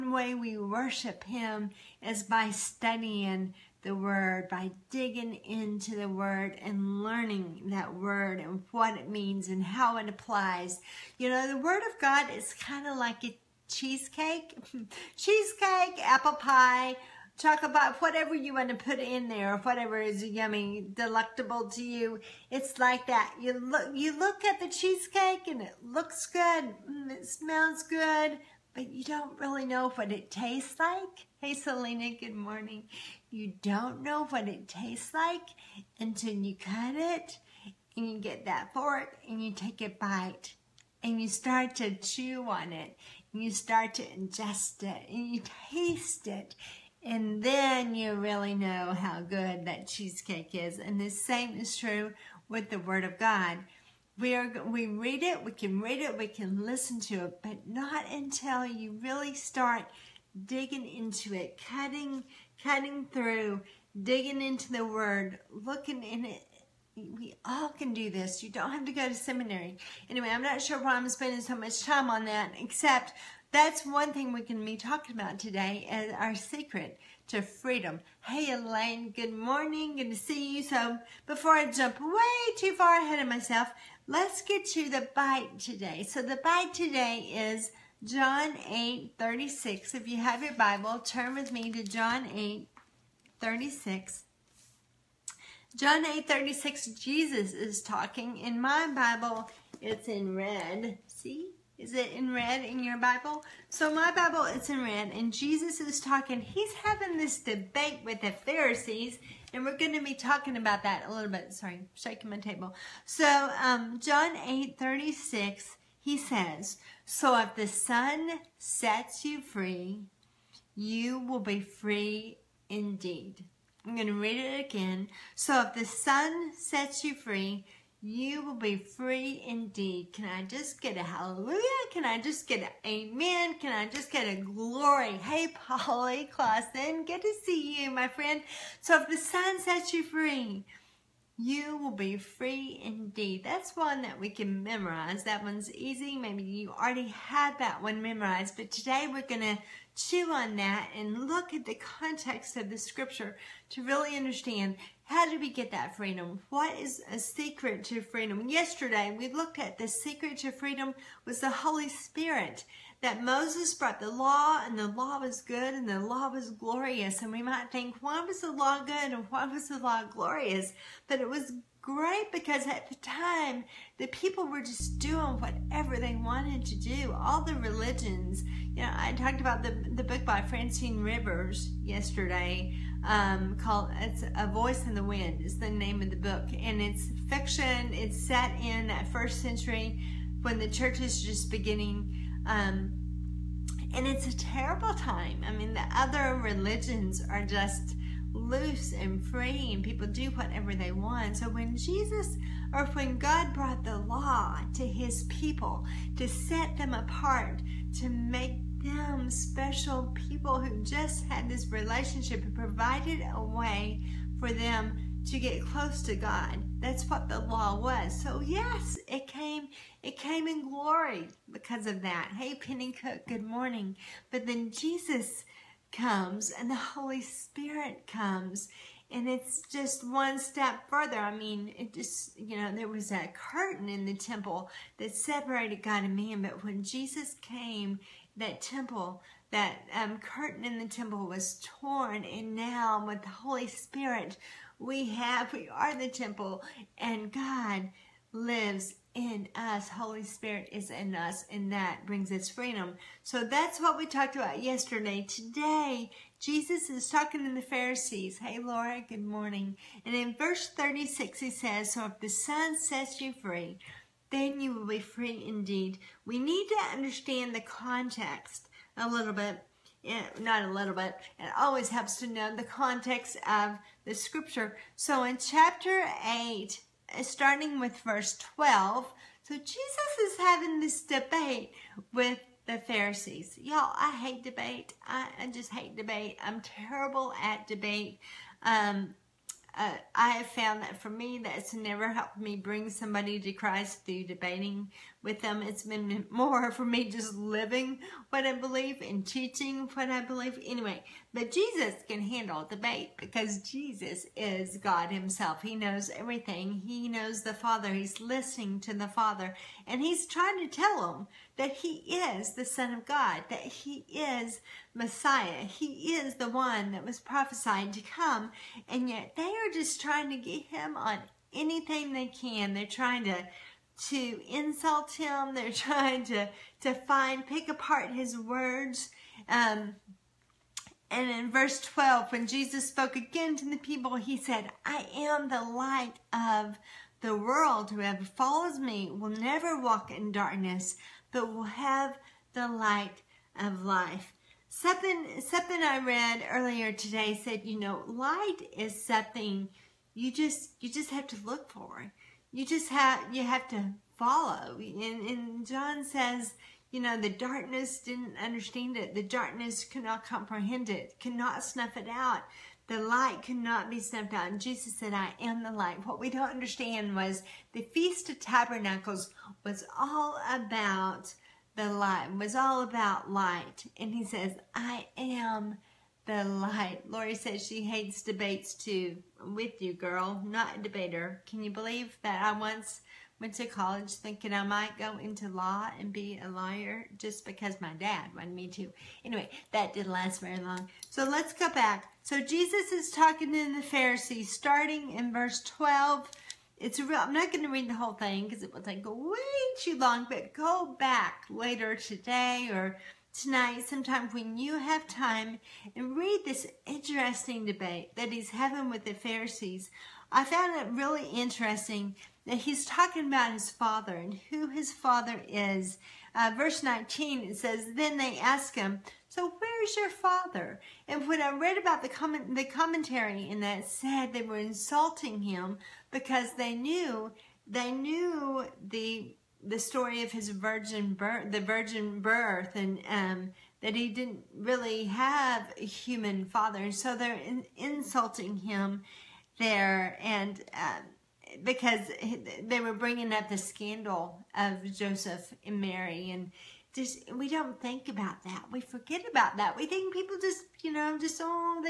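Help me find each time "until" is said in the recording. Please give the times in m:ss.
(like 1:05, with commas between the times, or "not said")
0:35, 0:58.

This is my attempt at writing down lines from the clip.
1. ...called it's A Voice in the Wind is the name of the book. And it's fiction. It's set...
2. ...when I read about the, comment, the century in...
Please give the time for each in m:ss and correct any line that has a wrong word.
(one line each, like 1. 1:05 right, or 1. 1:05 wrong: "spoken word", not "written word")
1. 3:03 right
2. 7:01 wrong: "commentary", not "century".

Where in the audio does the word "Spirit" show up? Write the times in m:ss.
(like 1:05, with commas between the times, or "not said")
2:41, 3:47, 4:03, 4:10.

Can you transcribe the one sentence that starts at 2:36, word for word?
What is a secret to freedom?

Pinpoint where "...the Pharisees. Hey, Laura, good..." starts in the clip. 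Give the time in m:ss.
4:17.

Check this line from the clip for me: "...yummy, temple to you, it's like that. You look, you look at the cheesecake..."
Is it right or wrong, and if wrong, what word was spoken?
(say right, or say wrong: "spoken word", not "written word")
wrong: "delectable", not "temple".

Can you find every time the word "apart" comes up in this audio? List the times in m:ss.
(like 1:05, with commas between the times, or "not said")
3:26, 5:27.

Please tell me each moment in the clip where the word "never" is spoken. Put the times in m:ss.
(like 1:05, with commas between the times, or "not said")
4:51, 5:39.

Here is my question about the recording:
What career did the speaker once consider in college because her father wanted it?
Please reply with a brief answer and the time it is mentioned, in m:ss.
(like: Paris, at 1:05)
Lawyer, at 6:26.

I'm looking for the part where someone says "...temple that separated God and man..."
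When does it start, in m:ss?
3:54.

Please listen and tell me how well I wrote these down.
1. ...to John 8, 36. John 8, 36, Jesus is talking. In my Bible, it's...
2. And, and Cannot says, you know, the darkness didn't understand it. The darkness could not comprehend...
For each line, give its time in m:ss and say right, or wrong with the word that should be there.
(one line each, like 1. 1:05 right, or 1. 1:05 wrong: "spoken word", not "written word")
1. 1:31 right
2. 5:54 wrong: "John", not "Cannot".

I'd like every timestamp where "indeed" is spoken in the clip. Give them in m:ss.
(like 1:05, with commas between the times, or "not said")
2:02, 2:09, 2:22, 4:25.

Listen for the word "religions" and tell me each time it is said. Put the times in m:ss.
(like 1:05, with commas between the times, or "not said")
2:57, 3:16.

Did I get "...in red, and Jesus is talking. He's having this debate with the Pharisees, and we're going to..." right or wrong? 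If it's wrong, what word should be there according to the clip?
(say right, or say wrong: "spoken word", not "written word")
right.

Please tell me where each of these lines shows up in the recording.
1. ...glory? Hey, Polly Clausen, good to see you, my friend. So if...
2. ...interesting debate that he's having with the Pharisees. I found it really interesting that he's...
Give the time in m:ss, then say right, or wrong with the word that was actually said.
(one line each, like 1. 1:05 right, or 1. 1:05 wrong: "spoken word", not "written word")
1. 2:14 right
2. 6:46 right.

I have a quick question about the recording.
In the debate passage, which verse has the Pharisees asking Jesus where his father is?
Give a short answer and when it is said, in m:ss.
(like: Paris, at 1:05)
Verse 19, at 6:56.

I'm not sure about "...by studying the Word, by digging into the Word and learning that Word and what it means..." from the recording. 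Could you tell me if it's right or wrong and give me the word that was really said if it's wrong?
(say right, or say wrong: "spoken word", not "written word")
right.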